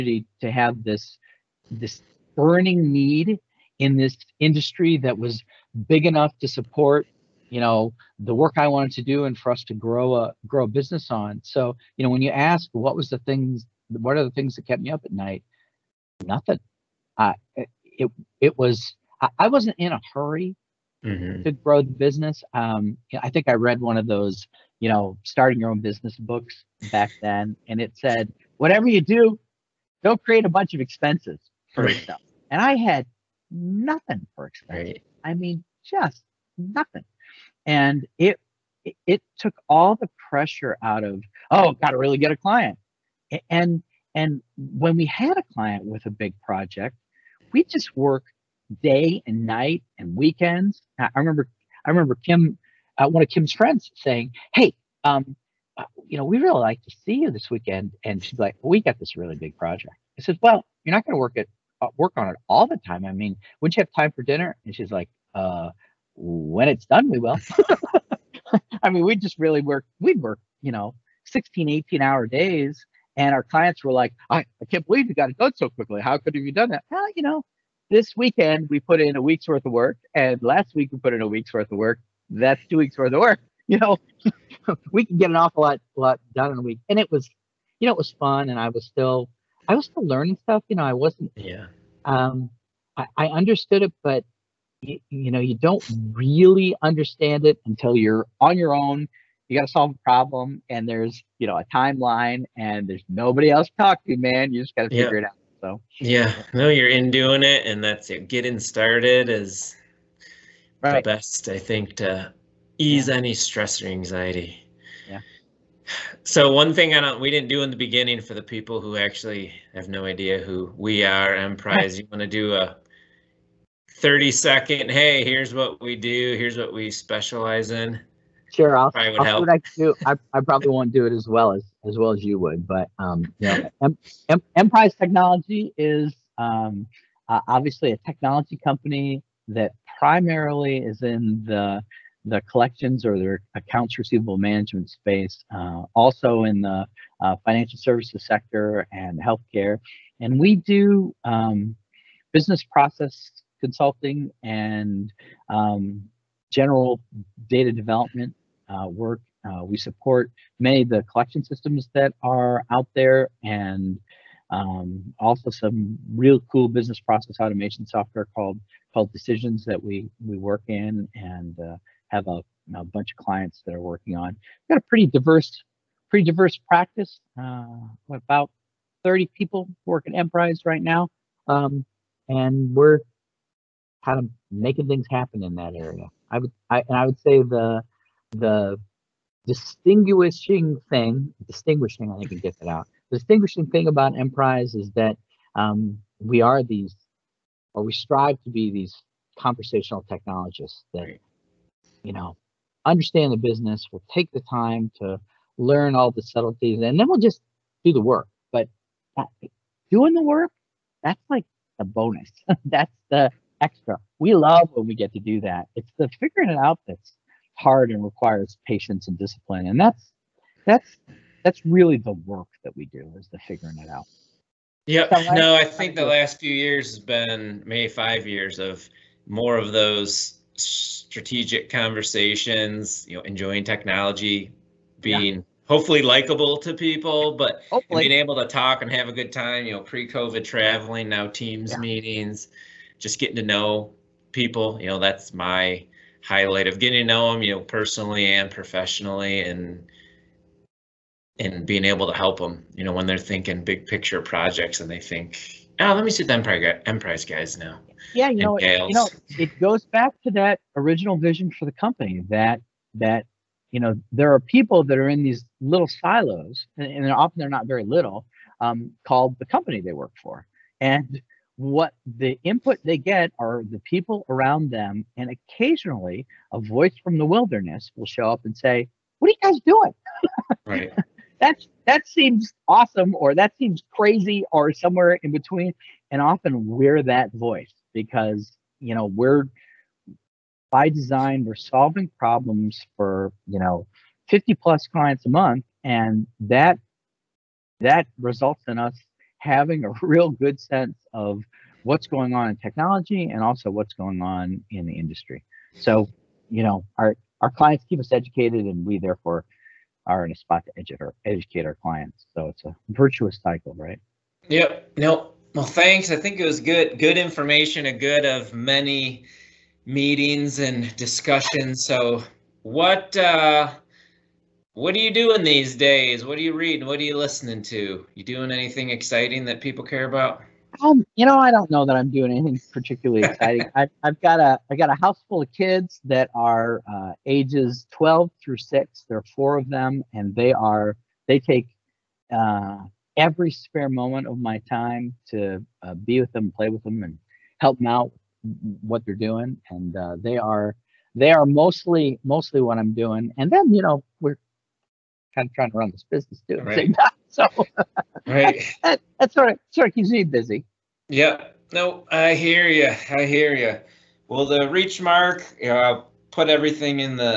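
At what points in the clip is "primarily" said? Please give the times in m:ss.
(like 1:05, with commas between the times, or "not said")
2:19.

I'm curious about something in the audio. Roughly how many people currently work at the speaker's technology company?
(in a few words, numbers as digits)
30.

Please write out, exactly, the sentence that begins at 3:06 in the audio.
I would I, and I would say the the distinguishing thing, distinguishing, I think we get that out.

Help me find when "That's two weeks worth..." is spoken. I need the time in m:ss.
1:22.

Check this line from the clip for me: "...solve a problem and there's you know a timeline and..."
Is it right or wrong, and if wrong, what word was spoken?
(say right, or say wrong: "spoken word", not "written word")
right.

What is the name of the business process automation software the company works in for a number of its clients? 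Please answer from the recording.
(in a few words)
Decisions.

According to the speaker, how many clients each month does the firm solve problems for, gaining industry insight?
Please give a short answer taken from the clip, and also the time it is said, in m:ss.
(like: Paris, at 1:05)
50 plus, at 4:54.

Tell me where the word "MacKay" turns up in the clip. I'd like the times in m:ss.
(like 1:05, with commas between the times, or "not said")
not said.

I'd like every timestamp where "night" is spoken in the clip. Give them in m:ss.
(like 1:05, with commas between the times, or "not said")
0:15, 0:49.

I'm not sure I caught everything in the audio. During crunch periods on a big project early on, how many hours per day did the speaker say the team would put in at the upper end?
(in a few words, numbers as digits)
18.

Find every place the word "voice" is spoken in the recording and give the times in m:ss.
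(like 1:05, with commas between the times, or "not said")
4:36, 4:47.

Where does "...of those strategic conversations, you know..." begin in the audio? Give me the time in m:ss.
3:49.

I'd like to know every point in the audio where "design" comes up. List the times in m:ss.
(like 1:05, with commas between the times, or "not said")
4:50.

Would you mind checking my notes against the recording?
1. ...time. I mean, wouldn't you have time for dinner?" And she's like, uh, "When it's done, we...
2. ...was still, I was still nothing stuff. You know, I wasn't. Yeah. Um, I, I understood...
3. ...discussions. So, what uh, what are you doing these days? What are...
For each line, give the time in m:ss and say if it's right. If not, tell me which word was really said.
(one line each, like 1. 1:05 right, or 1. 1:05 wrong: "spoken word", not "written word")
1. 1:02 right
2. 1:28 wrong: "learning", not "nothing"
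3. 5:20 right.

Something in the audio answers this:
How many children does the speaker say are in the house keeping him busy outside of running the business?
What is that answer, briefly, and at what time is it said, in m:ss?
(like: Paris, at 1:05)
4, at 5:39.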